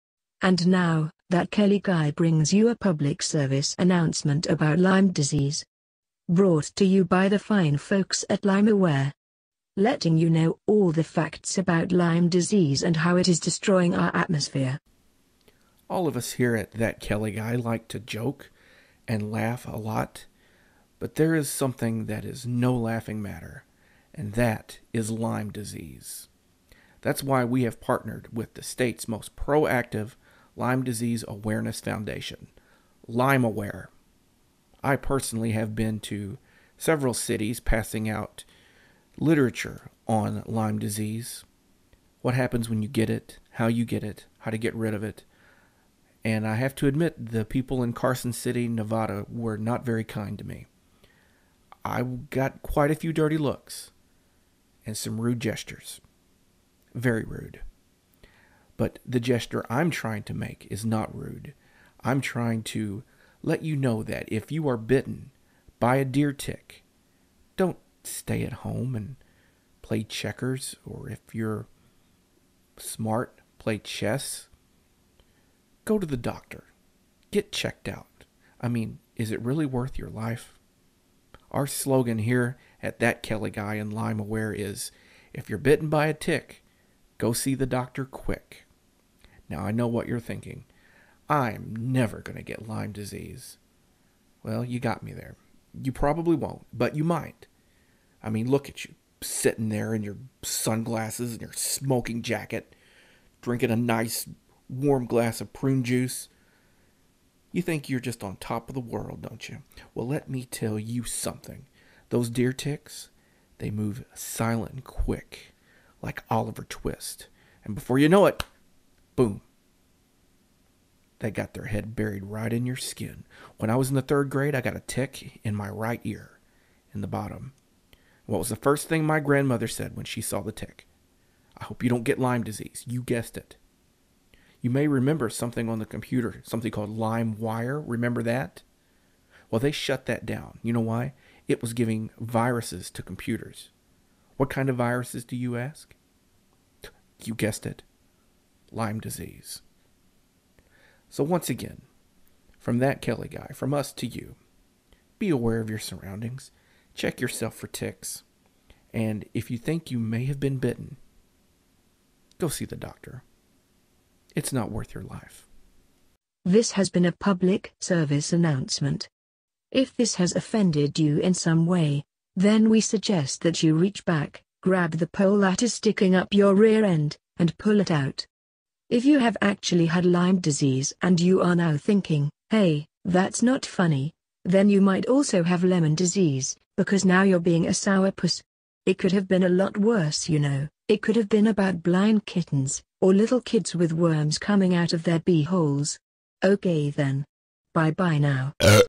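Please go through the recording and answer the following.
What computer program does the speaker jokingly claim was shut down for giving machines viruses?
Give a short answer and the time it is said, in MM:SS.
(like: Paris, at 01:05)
LimeWire, at 02:16.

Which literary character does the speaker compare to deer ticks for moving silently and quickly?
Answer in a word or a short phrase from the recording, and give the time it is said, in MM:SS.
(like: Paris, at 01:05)
Oliver Twist, at 01:56.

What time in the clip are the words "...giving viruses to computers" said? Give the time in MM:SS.
02:21.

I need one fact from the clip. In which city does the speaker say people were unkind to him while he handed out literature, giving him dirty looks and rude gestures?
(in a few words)
Carson City, Nevada.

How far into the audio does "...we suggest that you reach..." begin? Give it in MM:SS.
02:52.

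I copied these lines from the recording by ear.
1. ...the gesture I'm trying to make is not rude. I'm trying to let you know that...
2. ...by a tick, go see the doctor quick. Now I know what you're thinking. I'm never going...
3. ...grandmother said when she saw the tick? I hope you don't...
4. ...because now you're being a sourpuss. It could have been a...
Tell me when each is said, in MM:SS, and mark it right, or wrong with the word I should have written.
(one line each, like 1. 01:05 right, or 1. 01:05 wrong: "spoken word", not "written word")
1. 00:59 right
2. 01:25 right
3. 02:09 right
4. 03:06 right.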